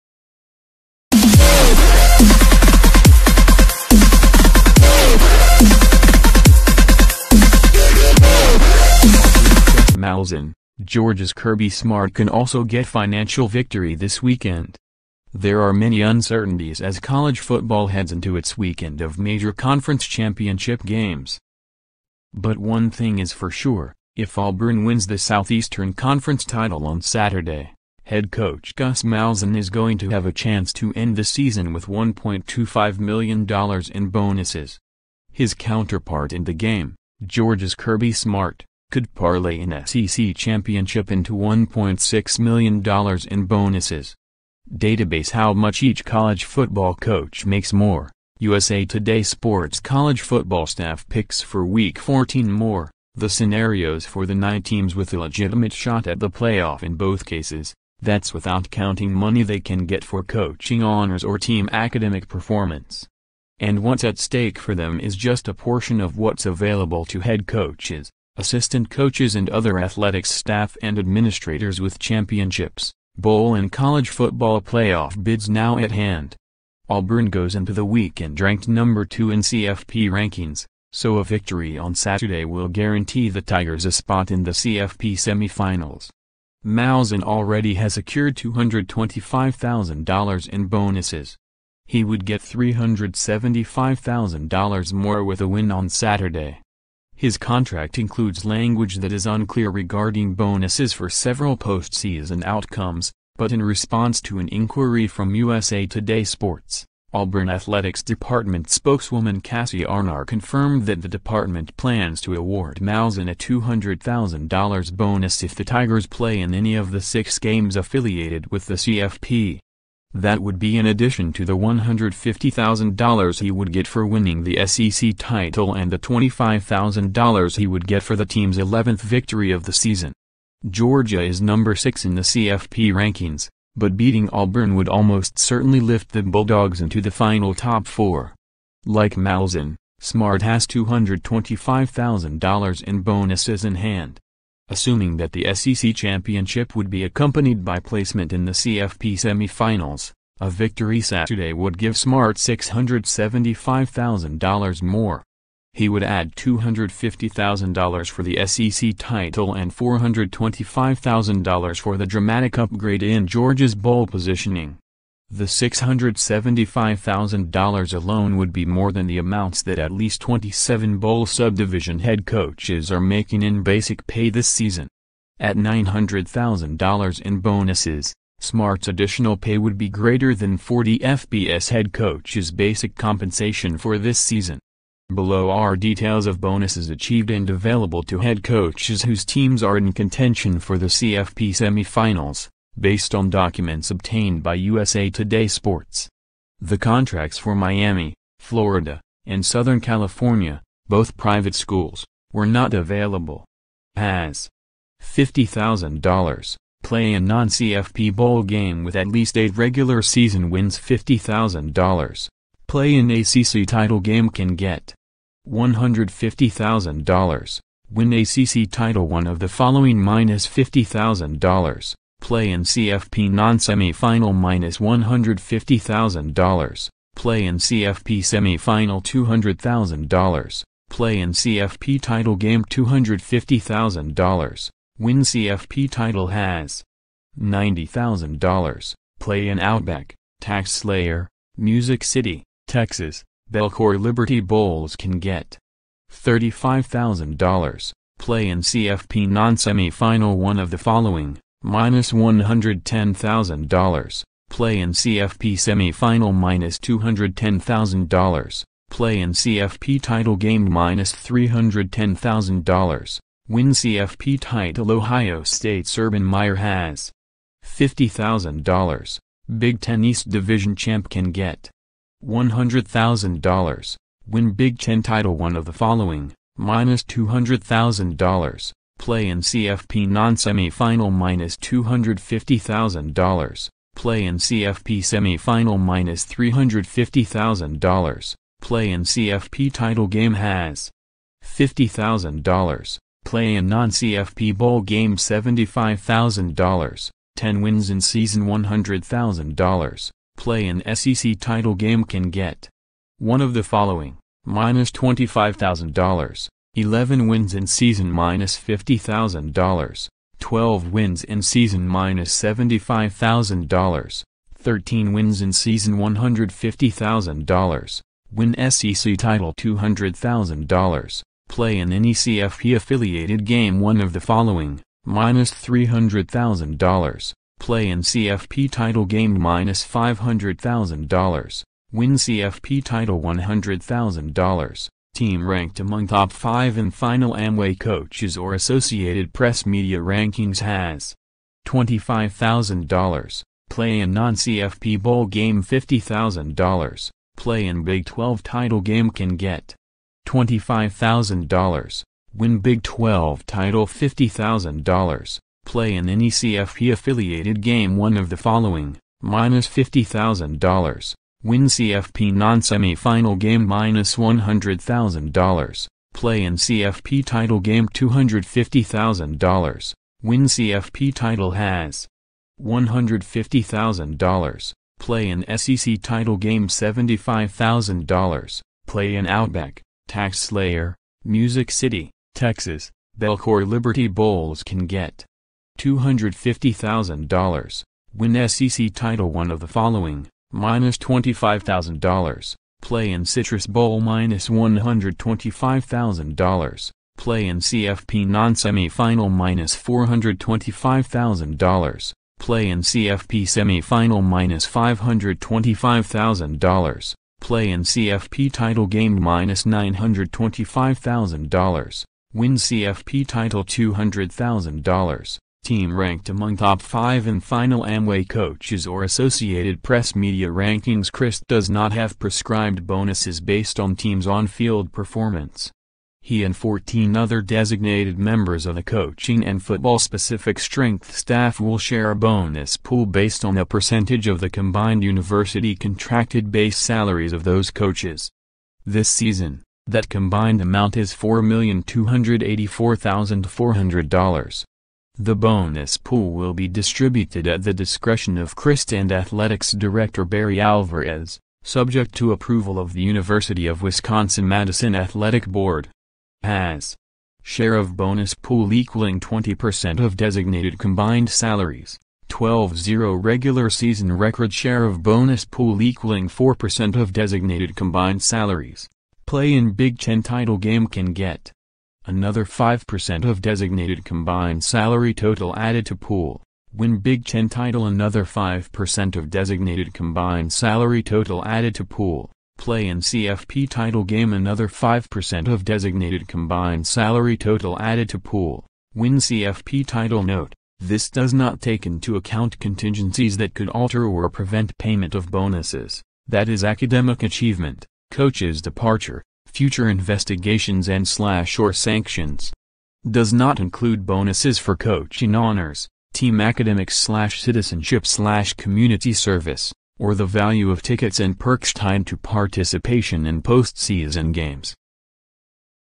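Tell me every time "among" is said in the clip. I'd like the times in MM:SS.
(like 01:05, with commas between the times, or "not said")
05:35, 06:56.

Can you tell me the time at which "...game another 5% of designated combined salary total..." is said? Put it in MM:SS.
08:04.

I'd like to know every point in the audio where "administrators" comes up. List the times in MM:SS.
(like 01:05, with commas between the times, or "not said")
01:10.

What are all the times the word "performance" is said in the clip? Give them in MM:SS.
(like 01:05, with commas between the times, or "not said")
01:02, 07:04.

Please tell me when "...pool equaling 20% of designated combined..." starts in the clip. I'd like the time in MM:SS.
07:38.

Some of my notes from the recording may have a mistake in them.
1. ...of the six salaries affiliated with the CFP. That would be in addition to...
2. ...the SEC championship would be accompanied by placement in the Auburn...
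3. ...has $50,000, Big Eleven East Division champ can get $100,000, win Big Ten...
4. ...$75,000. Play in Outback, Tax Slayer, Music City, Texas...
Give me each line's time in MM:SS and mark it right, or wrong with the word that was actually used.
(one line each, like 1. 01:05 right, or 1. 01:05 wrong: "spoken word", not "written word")
1. 01:56 wrong: "games", not "salaries"
2. 02:25 wrong: "CFP", not "Auburn"
3. 04:26 wrong: "Ten", not "Eleven"
4. 06:16 right.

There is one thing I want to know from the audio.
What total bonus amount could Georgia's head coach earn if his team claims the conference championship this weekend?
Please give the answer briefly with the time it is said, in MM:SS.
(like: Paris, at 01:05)
$1.6 million, at 00:41.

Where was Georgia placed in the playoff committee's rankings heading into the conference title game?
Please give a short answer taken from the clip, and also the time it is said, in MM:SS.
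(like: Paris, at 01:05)
number 6, at 02:11.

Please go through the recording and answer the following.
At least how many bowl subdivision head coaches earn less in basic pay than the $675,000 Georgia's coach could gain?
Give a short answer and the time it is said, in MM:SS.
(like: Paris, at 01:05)
27, at 02:50.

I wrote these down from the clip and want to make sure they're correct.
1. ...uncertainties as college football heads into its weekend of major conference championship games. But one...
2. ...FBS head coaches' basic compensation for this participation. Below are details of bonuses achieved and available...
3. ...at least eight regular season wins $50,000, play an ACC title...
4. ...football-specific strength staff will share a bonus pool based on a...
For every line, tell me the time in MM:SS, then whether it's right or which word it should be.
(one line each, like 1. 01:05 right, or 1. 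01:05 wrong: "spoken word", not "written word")
1. 00:16 right
2. 03:00 wrong: "season", not "participation"
3. 03:28 right
4. 07:09 right.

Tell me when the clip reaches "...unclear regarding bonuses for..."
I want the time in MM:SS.
01:39.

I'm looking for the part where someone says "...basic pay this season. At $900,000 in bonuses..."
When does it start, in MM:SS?
02:53.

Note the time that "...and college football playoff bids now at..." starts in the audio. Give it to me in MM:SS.
01:13.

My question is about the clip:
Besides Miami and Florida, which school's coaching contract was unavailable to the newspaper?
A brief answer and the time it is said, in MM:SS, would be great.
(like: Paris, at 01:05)
Southern California, at 03:19.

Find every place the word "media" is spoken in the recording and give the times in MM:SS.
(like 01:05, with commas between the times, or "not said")
05:39, 07:00.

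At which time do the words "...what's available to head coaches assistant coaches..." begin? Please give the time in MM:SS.
01:06.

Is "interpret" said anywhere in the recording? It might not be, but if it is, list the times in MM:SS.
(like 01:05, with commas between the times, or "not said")
not said.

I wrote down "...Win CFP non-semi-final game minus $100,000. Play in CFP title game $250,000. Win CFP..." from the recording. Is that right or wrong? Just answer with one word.
right.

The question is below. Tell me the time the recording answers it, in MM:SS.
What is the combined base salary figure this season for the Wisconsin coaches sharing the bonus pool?
07:21.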